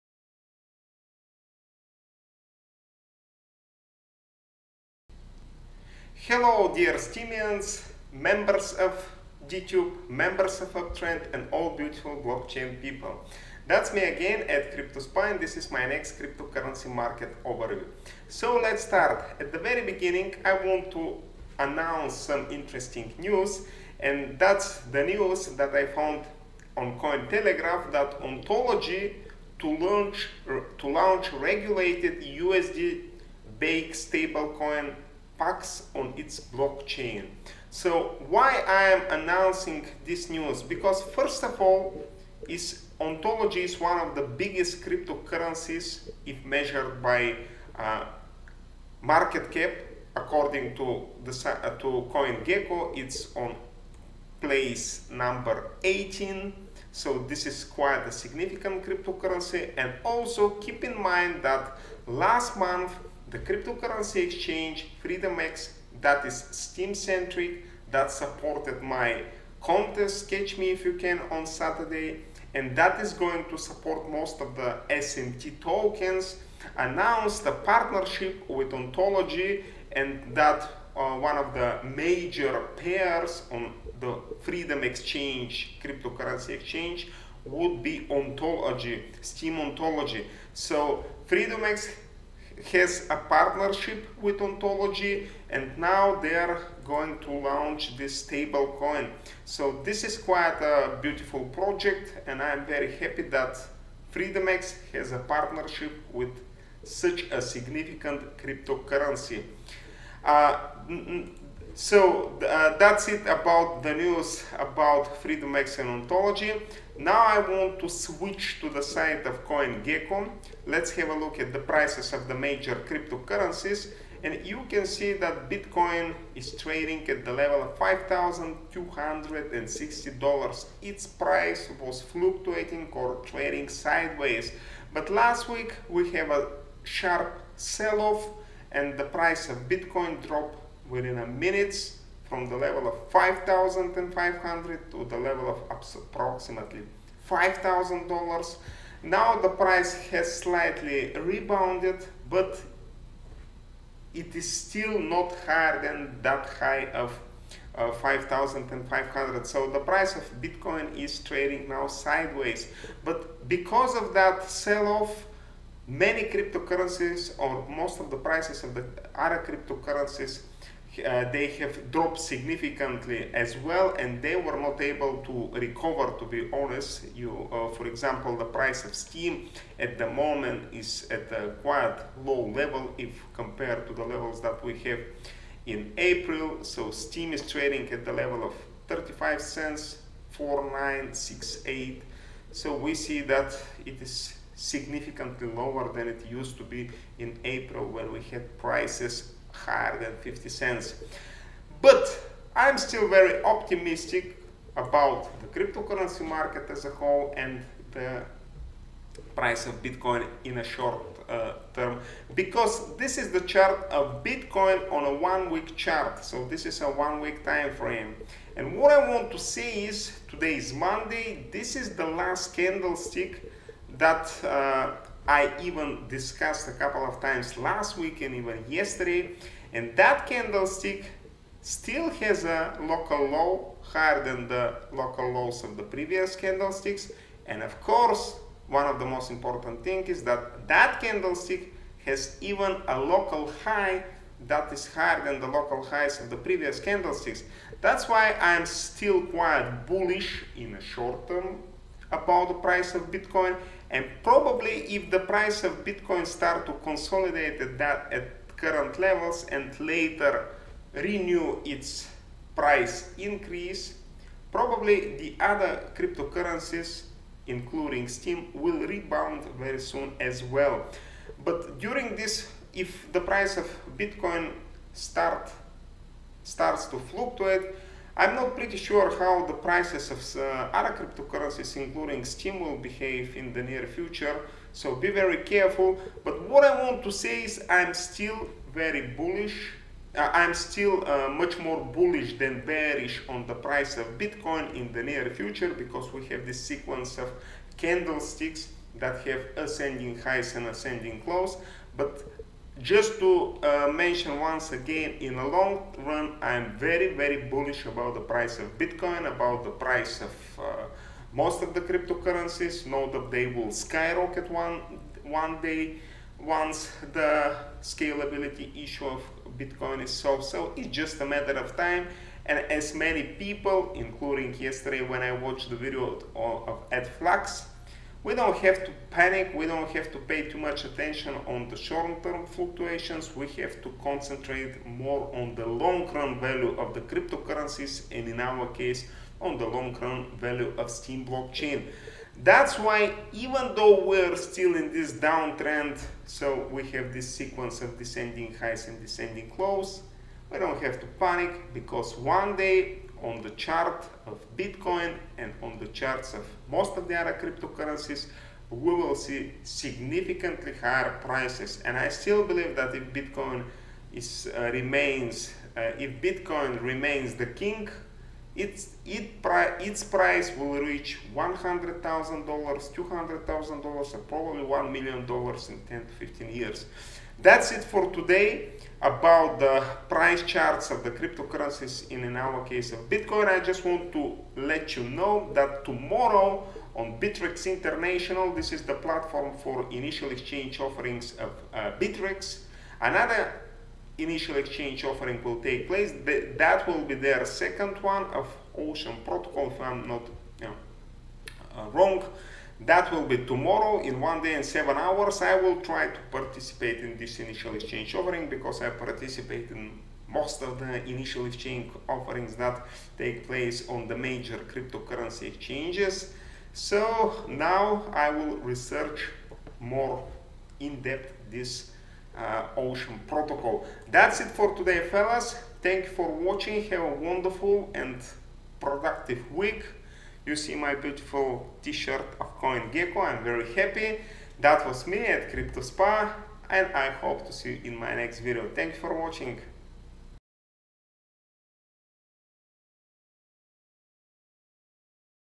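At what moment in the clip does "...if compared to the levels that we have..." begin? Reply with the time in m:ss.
3:02.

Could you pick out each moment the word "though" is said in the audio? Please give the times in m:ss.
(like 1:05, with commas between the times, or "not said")
5:43.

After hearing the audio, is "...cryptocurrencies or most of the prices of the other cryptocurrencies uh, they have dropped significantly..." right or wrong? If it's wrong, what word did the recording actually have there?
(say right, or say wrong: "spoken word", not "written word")
right.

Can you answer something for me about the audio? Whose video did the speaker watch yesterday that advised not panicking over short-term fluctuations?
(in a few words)
Ed Flux.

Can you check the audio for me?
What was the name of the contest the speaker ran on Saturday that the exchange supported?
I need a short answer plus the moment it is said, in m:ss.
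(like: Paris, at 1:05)
Catch Me If You Can, at 1:10.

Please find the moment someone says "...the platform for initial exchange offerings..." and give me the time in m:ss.
6:28.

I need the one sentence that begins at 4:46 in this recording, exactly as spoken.
But what I want to say is I'm still very bullish.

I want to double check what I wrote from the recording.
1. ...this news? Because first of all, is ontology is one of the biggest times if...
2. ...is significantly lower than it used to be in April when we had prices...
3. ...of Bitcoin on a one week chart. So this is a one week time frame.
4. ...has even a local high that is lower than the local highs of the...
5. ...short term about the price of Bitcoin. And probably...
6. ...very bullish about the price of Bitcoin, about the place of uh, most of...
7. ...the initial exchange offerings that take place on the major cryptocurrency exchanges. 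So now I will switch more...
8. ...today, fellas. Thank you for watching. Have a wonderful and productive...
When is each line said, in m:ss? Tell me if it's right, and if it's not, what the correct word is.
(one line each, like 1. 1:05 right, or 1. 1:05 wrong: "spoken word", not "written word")
1. 0:40 wrong: "cryptocurrencies", not "times"
2. 3:14 right
3. 3:33 right
4. 4:02 wrong: "higher", not "lower"
5. 4:10 right
6. 5:07 wrong: "price", not "place"
7. 6:50 wrong: "research", not "switch"
8. 7:04 right.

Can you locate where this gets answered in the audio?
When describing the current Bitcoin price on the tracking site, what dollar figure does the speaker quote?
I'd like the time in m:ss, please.
2:07.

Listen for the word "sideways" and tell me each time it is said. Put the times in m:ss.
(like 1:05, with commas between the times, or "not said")
2:13, 2:41.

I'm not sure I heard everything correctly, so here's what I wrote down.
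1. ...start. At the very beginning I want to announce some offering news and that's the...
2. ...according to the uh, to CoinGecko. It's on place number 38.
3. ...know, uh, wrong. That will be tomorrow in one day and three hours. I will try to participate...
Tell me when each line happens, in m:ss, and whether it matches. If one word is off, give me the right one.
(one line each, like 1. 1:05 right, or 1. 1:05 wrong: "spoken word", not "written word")
1. 0:18 wrong: "interesting", not "offering"
2. 0:50 wrong: "18", not "38"
3. 6:40 wrong: "seven", not "three".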